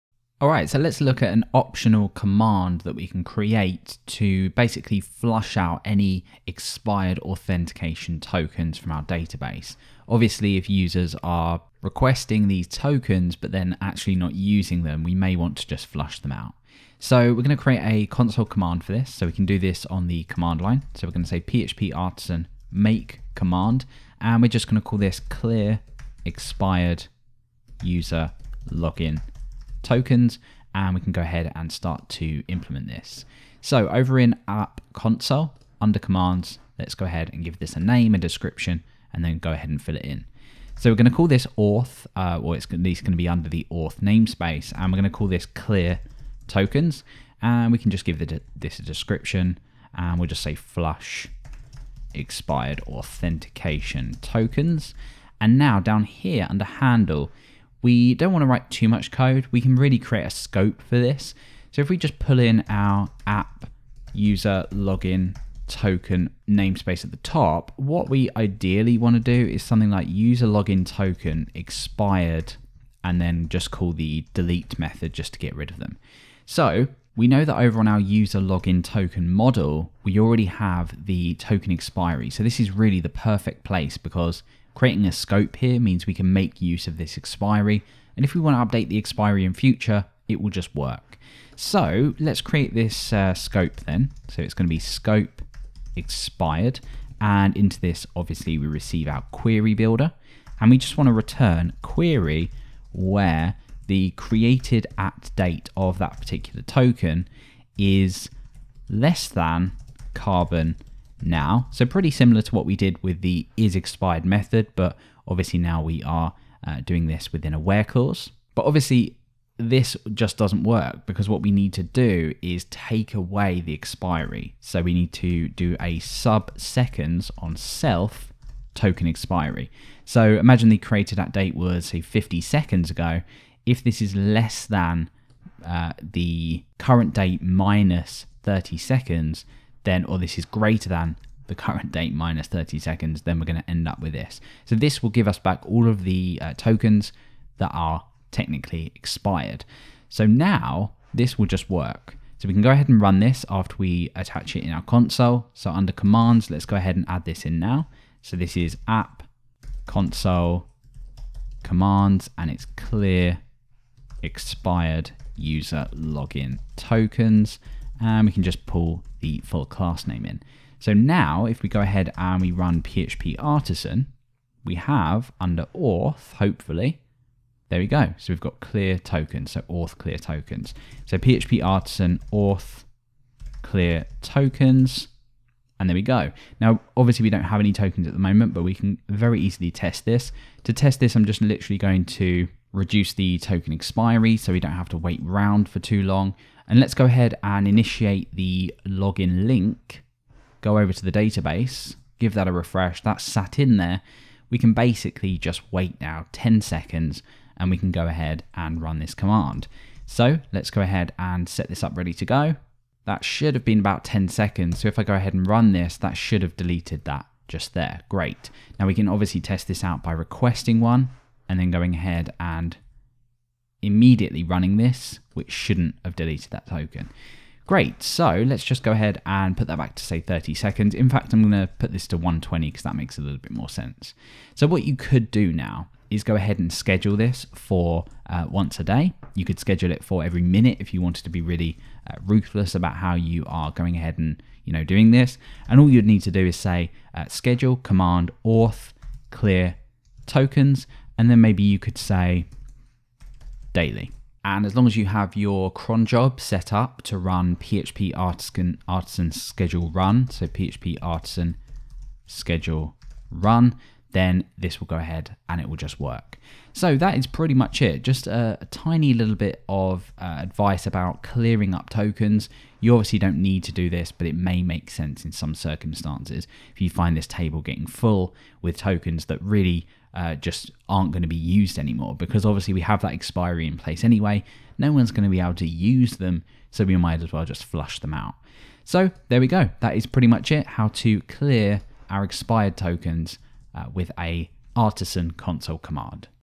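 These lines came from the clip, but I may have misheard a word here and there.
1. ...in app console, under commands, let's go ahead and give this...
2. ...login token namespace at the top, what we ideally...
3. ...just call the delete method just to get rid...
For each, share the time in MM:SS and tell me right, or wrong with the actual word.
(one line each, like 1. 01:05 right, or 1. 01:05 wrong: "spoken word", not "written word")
1. 00:34 right
2. 01:04 right
3. 01:13 right.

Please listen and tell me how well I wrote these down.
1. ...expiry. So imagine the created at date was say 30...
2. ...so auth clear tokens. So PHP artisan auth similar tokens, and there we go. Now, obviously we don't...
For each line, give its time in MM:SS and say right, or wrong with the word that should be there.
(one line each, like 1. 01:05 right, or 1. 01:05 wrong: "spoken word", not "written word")
1. 02:09 wrong: "50", not "30"
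2. 02:59 wrong: "clear", not "similar".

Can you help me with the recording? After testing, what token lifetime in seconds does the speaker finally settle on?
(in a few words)
120.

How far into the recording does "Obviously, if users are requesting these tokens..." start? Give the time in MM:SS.
00:10.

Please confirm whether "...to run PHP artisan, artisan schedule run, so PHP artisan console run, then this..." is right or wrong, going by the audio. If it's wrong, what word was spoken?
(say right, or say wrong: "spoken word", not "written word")
wrong: "schedule", not "console".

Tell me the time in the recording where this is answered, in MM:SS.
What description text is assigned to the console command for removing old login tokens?
00:50.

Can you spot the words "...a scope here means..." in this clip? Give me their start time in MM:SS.
01:25.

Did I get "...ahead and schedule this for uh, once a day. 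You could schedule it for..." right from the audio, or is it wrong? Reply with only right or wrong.
right.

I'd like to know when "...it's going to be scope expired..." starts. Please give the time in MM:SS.
01:34.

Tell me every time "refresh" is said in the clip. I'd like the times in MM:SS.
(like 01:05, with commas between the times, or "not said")
03:22.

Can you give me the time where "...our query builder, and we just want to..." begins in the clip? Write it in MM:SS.
01:39.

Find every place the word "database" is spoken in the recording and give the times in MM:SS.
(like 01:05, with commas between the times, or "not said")
00:09, 03:21.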